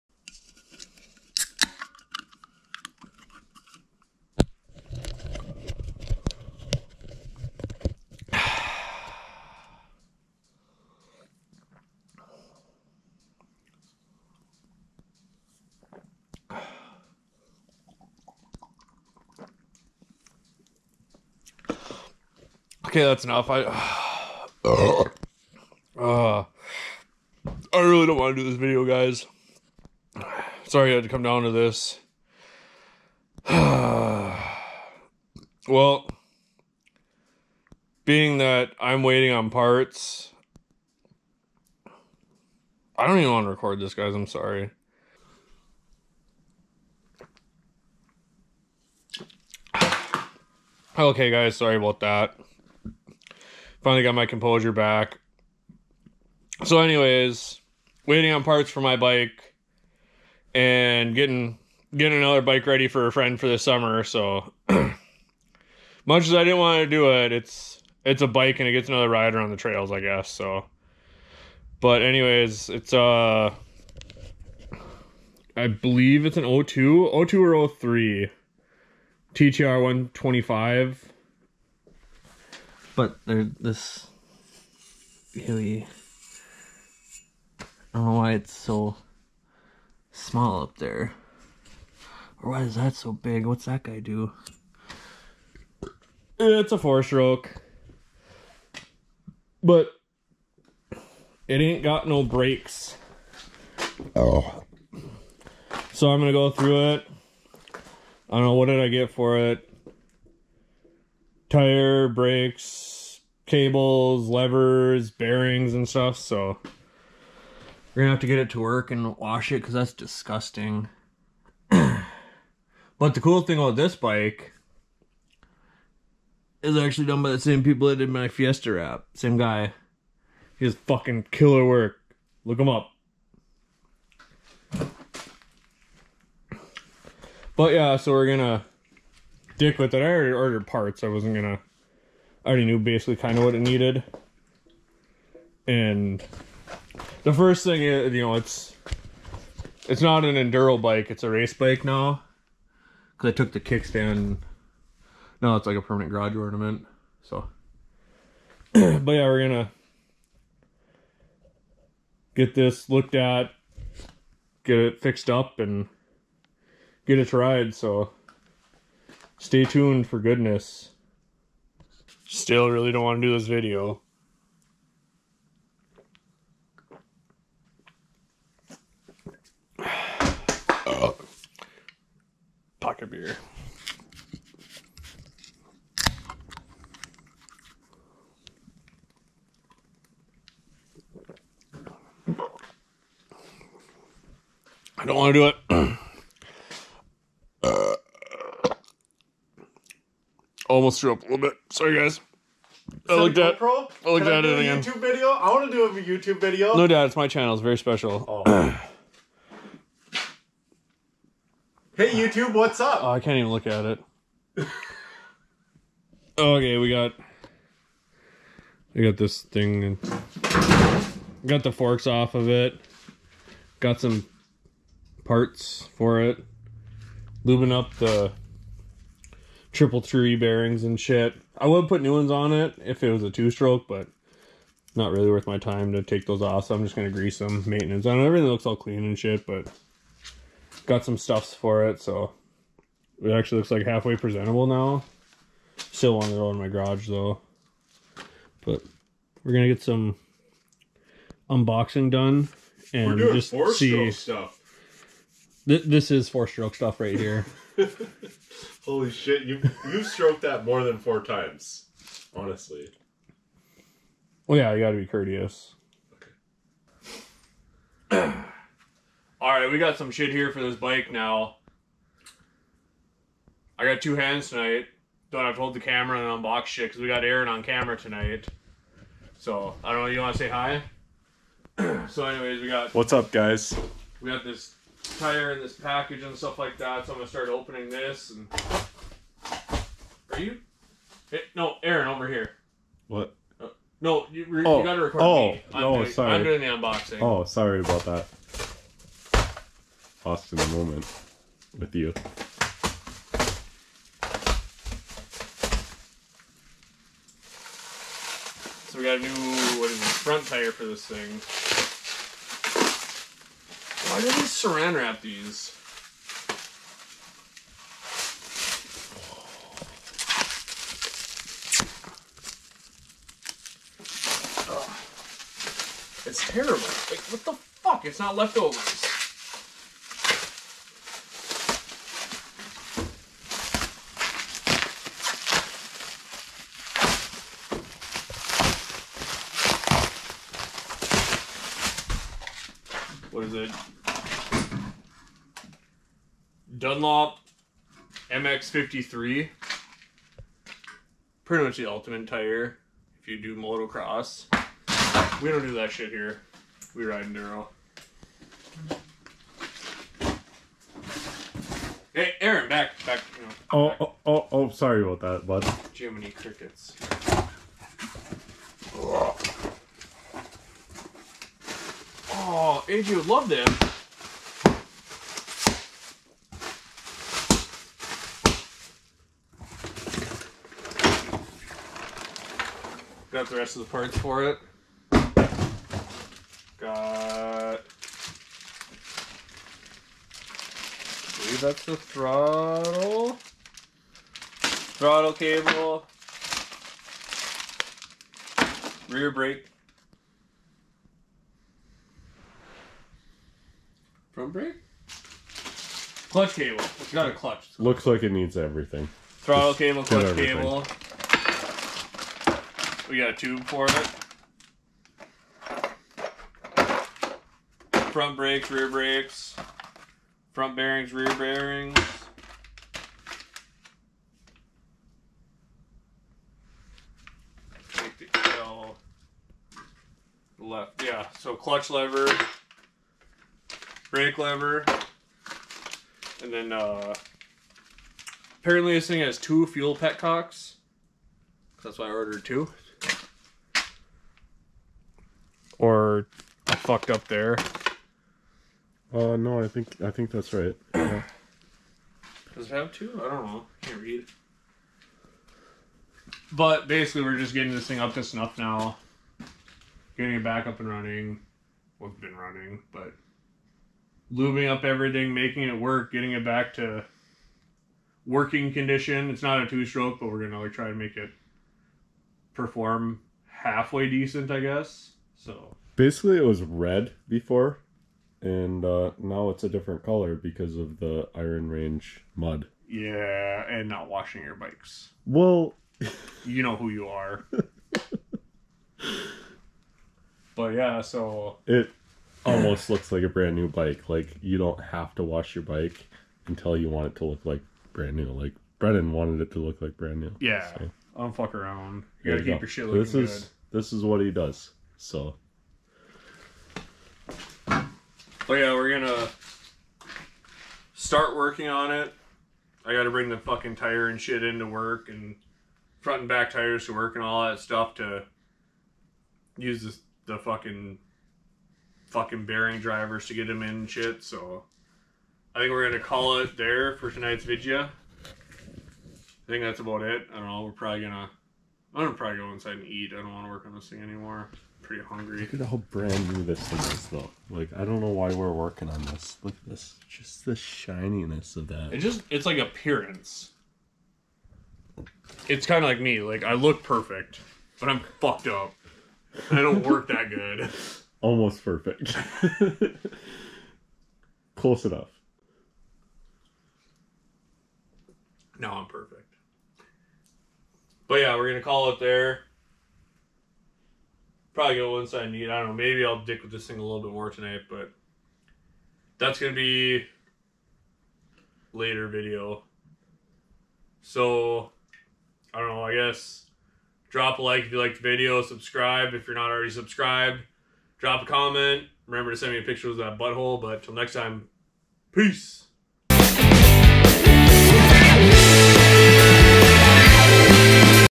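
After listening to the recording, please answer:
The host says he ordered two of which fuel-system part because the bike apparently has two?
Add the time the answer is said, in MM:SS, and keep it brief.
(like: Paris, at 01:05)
fuel petcocks, at 07:19.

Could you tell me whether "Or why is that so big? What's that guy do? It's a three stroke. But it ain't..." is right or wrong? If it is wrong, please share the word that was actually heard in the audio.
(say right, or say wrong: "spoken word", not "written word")
wrong: "four", not "three".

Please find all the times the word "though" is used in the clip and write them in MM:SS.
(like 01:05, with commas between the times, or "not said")
04:07, 08:57.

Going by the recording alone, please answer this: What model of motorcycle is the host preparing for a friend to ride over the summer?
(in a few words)
TTR 125.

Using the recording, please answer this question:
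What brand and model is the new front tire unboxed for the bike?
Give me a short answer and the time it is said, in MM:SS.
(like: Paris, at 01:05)
Dunlop MX53, at 05:46.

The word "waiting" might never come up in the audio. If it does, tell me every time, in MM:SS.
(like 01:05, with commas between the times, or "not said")
00:39, 00:58.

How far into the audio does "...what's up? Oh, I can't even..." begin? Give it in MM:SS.
03:32.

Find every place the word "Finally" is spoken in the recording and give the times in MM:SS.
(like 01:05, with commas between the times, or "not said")
00:53.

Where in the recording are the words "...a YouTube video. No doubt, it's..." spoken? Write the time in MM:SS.
03:25.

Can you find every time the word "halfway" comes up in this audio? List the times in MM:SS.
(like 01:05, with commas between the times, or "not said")
04:03, 07:53.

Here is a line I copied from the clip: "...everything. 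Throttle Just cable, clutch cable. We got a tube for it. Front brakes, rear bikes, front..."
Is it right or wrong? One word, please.
wrong.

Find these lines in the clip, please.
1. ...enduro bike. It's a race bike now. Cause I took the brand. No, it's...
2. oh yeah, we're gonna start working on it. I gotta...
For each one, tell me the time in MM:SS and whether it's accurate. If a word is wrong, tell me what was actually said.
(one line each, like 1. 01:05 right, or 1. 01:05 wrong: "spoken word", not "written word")
1. 02:30 wrong: "kickstand", not "brand"
2. 08:27 right.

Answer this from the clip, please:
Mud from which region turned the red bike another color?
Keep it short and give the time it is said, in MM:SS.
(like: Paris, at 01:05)
Iron Range, at 08:01.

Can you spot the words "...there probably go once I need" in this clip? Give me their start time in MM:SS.
09:22.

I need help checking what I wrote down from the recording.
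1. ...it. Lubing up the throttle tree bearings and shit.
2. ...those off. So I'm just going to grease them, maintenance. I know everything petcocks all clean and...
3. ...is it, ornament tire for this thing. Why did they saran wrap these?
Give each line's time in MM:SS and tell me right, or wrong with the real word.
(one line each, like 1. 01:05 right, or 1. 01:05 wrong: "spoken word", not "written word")
1. 03:46 wrong: "triple", not "throttle"
2. 03:56 wrong: "looks", not "petcocks"
3. 05:09 wrong: "front", not "ornament".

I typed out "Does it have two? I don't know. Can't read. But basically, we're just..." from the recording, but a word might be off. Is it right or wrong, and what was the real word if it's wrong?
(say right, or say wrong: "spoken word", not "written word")
right.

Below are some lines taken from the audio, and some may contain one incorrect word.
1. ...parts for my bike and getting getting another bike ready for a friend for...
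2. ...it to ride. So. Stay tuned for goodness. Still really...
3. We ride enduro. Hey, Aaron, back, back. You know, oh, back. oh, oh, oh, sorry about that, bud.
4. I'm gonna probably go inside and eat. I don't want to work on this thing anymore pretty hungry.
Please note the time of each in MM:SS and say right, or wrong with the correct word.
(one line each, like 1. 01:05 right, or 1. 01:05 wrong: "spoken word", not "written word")
1. 00:58 right
2. 02:47 right
3. 05:56 right
4. 08:51 right.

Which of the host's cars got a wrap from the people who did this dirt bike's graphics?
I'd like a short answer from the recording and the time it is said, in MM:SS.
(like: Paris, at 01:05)
Fiesta, at 02:08.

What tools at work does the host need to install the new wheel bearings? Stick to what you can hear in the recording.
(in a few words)
bearing drivers.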